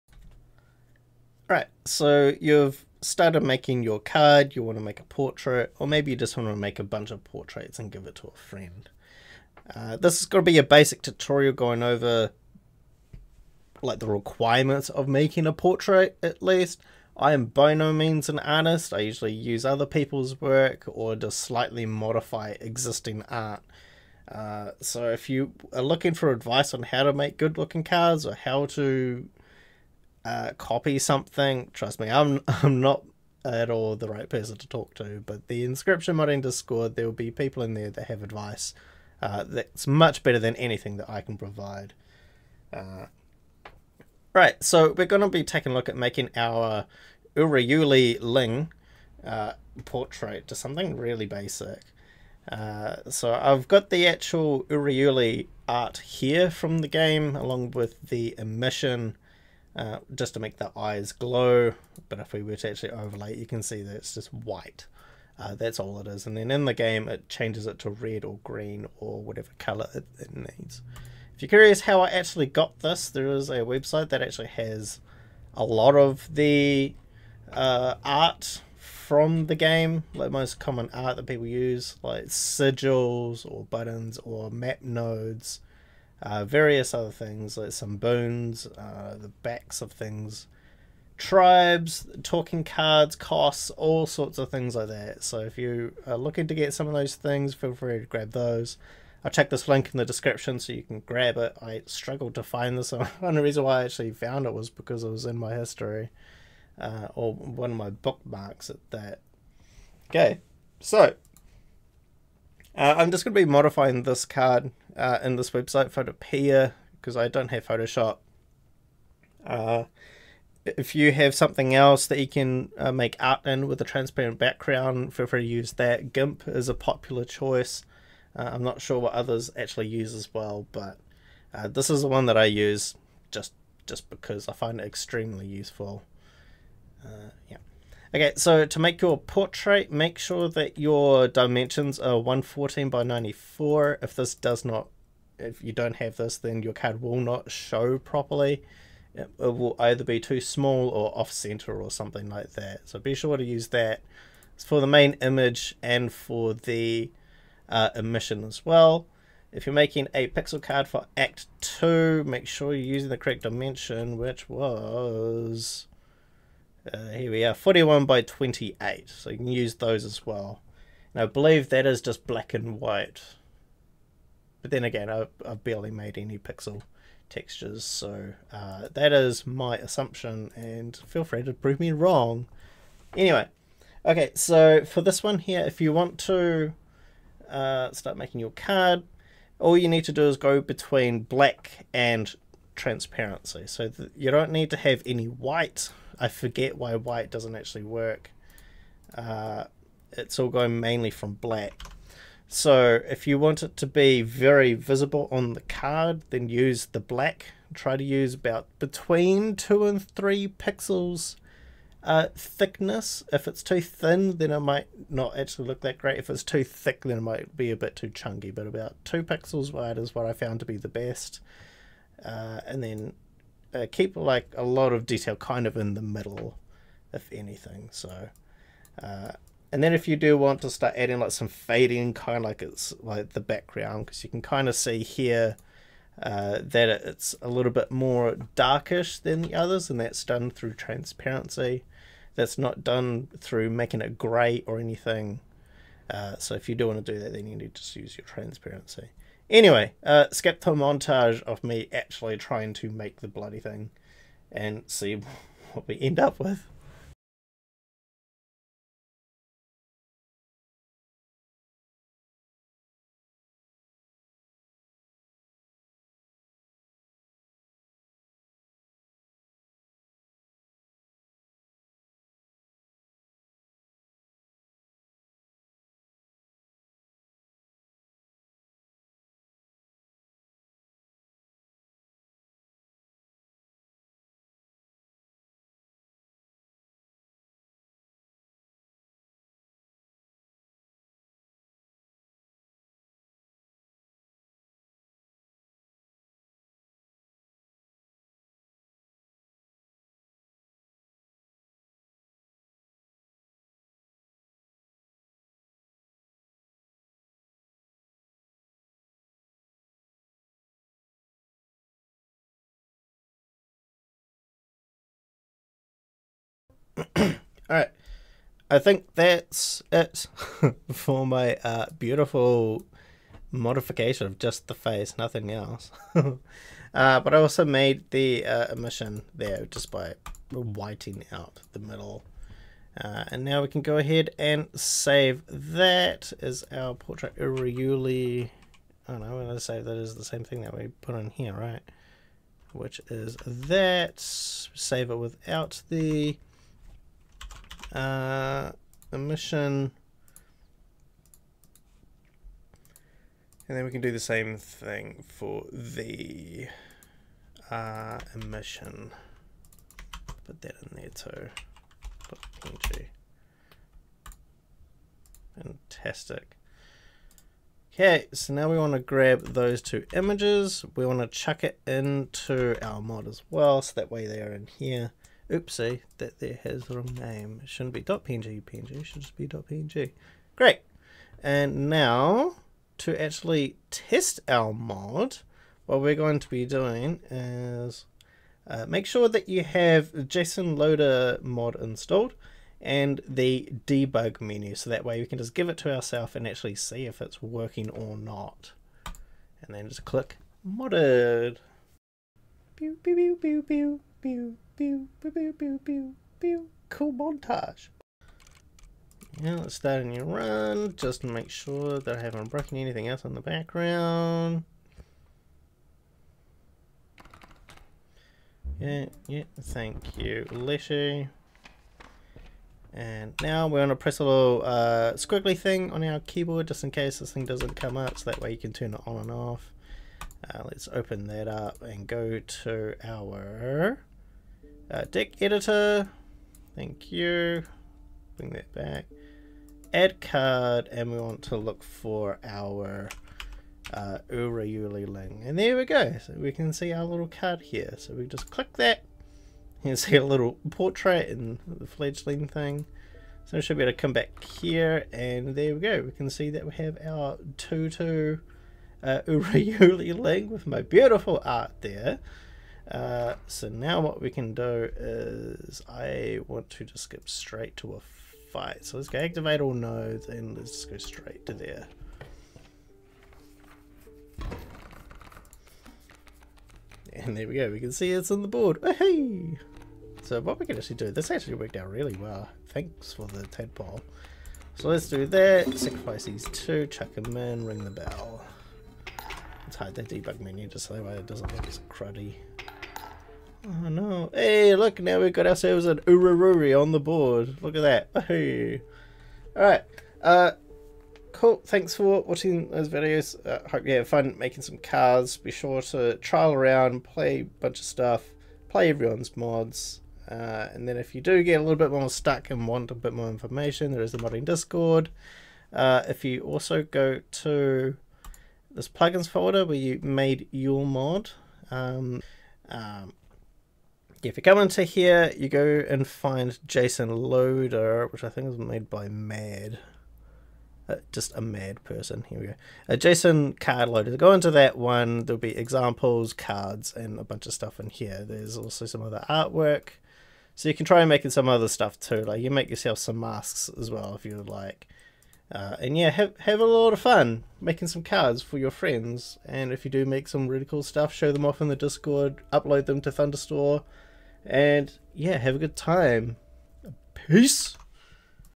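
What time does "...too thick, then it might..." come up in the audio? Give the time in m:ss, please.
3:36.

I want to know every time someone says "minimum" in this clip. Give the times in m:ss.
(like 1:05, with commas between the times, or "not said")
not said.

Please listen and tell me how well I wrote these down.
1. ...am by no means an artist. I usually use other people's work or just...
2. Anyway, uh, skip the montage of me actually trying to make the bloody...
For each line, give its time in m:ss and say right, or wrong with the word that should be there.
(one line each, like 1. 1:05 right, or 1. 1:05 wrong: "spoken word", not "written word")
1. 0:17 right
2. 4:09 right.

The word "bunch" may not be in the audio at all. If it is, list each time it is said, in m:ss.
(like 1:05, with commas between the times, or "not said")
0:06, 8:27, 8:57.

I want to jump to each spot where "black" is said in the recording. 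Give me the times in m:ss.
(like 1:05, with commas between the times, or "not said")
2:52, 3:11, 3:21, 3:26.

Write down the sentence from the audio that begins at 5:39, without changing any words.
don't oh, when I save that is the same thing that we put in here, right?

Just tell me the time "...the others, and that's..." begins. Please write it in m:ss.
3:59.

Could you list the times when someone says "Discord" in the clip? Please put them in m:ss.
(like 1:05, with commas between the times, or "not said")
0:36, 8:34, 9:11.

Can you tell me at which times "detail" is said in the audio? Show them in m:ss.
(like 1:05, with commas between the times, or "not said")
3:45.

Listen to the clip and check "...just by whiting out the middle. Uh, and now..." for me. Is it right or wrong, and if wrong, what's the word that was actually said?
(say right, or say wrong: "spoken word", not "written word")
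right.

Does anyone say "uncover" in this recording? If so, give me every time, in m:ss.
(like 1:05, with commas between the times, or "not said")
not said.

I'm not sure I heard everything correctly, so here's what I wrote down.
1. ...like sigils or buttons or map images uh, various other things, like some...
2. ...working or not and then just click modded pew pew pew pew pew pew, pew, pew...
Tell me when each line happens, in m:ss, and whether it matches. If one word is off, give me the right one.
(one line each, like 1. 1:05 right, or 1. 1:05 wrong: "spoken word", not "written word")
1. 1:22 wrong: "nodes", not "images"
2. 6:37 right.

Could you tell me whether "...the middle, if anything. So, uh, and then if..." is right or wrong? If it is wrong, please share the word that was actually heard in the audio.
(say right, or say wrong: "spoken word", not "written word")
right.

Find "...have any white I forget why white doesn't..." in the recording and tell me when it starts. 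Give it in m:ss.
3:14.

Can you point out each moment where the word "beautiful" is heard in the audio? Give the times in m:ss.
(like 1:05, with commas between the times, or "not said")
5:21, 7:40.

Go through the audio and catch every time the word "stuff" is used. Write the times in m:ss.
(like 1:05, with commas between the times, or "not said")
8:27, 8:57, 9:01, 9:10.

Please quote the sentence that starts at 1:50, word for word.
Okay, so uh, I'm just going to be modifying this card uh, in this website Photopea because I don't have Photoshop.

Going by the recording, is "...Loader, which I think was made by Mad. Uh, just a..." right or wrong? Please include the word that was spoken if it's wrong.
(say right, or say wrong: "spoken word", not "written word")
right.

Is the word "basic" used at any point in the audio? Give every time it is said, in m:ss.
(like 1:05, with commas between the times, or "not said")
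0:10, 0:51.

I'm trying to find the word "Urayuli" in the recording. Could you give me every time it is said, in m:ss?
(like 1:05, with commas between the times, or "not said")
0:47, 0:54, 7:24, 7:39.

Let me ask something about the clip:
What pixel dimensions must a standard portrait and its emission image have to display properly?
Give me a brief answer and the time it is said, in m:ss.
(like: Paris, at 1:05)
114 by 94, at 2:22.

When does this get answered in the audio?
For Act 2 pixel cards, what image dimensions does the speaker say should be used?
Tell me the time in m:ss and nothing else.
2:47.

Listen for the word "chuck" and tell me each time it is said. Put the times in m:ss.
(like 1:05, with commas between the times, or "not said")
6:11, 8:06.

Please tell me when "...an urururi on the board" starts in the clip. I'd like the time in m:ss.
8:15.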